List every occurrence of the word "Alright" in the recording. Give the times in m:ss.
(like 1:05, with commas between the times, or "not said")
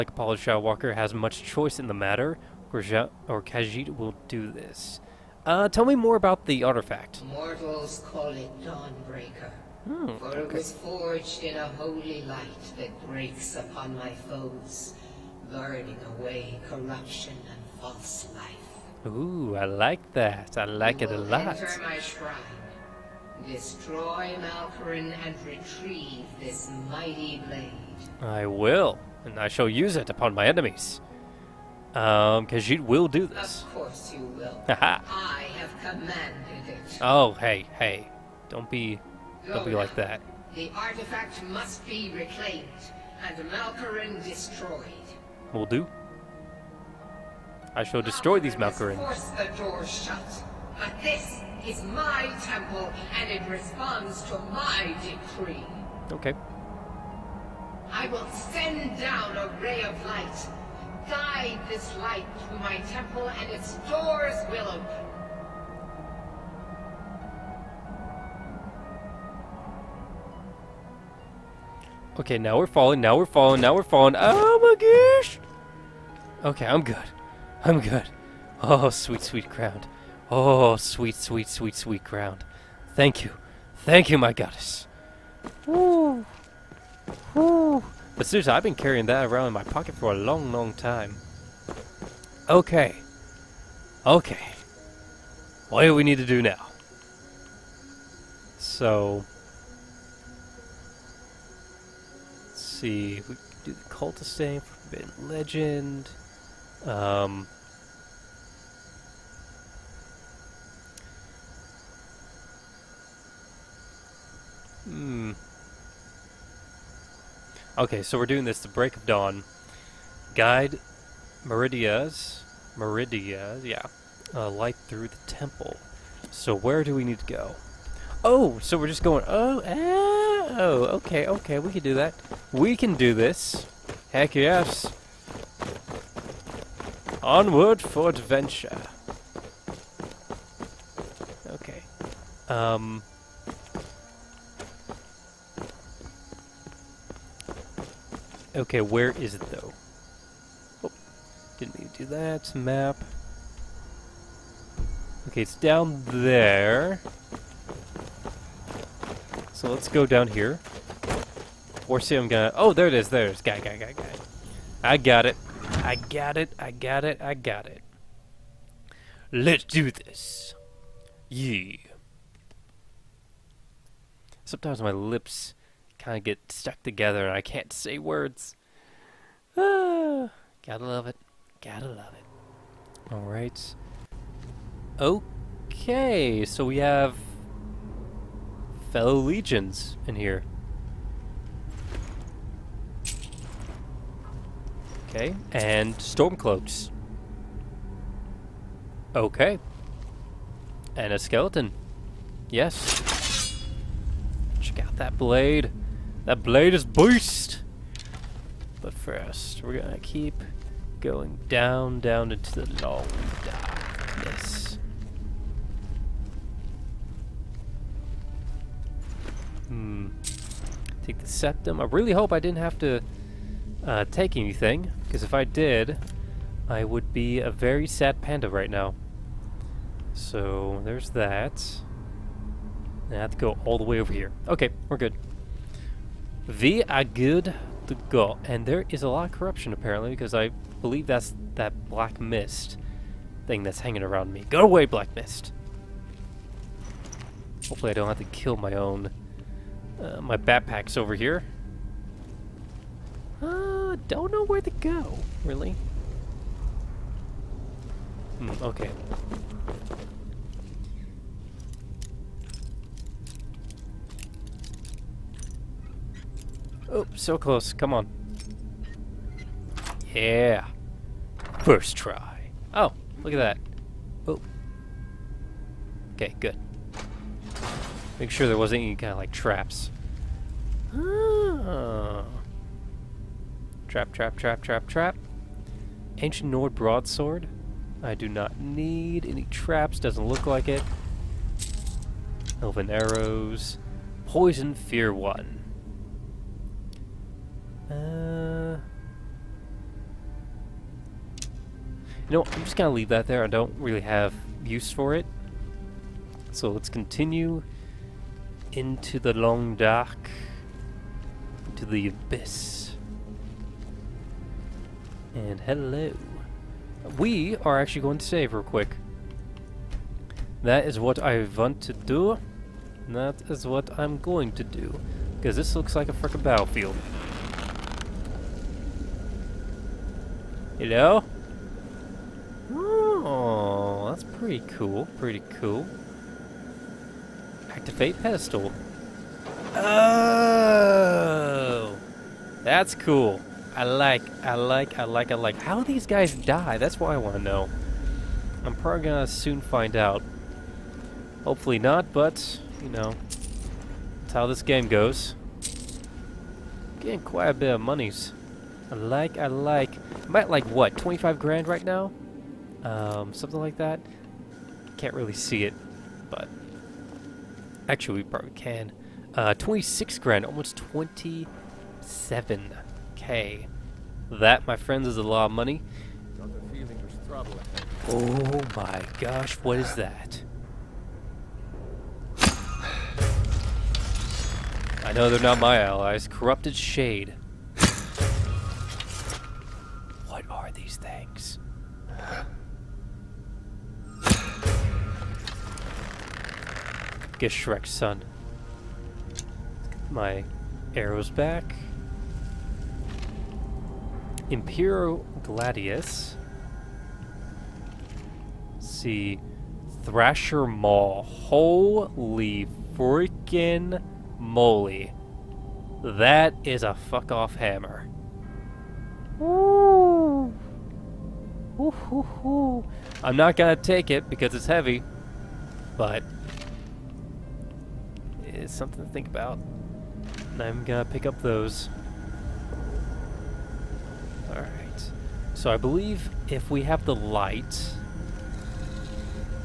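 3:03, 7:14.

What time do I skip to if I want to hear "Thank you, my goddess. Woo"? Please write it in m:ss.
1:23.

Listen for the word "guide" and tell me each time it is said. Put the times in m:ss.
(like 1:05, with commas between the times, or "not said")
1:01, 2:00.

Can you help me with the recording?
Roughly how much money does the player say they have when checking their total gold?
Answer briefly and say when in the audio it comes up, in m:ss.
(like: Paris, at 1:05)
almost 27k, at 6:10.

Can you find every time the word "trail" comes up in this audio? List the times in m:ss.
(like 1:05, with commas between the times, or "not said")
not said.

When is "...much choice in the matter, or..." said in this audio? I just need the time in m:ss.
0:01.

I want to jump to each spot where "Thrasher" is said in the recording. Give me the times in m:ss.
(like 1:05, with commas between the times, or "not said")
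6:50.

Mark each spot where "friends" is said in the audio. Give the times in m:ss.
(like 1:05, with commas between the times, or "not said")
6:14.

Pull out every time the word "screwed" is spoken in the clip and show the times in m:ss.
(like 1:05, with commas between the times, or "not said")
not said.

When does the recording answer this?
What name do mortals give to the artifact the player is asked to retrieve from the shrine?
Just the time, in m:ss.
0:08.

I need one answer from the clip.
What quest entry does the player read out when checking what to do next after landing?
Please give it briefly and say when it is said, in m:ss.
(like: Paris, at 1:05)
The Cult of Forbidden Legend, at 1:43.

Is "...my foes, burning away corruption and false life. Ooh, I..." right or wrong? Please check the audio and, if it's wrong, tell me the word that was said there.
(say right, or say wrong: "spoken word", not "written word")
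right.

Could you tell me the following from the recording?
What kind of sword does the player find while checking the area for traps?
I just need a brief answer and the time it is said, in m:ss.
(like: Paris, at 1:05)
Ancient Nord broadsword, at 4:46.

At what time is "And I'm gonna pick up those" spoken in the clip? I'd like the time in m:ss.
7:10.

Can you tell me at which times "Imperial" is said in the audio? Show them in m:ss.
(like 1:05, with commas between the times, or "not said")
6:44.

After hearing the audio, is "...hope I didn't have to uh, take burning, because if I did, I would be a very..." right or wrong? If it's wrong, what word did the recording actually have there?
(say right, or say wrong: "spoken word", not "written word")
wrong: "anything", not "burning".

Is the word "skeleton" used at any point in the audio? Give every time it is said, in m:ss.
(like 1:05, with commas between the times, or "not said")
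3:21.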